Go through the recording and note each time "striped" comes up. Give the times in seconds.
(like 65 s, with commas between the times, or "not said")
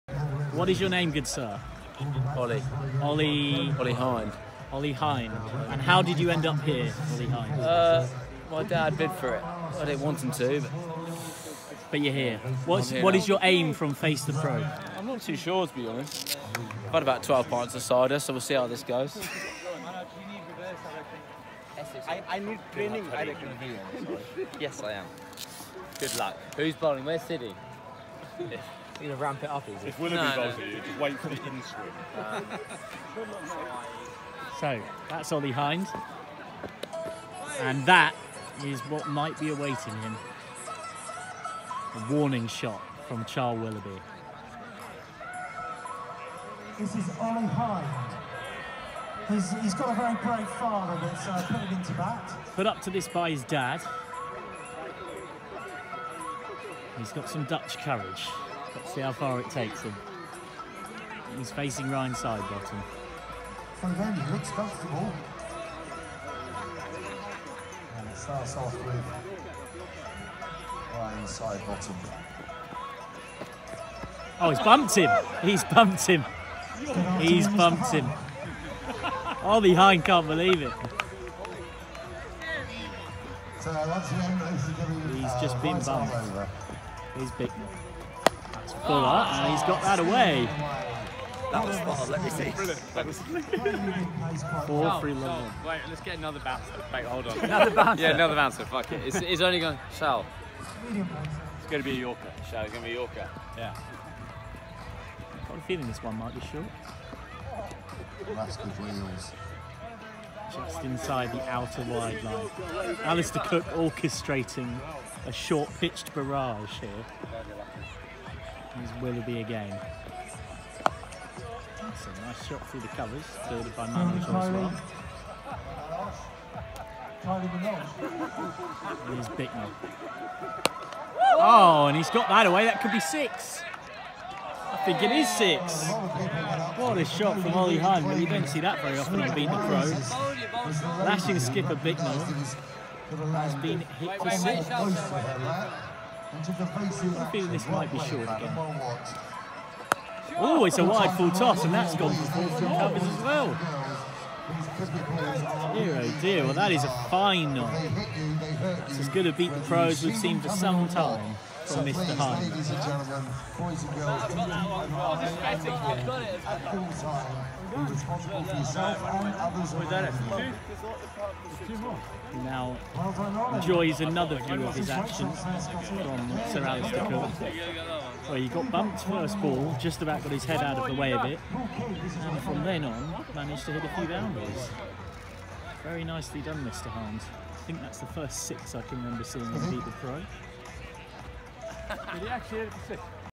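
not said.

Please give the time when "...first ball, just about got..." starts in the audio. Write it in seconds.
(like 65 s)
179 s.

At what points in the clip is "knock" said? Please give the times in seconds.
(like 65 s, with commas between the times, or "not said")
157 s.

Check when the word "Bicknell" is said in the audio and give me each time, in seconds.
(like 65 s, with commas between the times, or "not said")
129 s, 141 s.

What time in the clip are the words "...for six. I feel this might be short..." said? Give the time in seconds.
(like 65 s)
144 s.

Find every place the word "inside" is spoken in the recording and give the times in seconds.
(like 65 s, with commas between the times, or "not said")
110 s.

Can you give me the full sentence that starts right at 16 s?
I've had about 12 pints of cider, so we'll see how this goes.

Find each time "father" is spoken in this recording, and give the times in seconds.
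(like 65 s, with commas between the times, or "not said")
50 s.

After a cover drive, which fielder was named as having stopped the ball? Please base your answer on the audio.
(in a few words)
Manuel.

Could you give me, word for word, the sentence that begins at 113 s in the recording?
Alastair Cook orchestrating a short pitched barrage here.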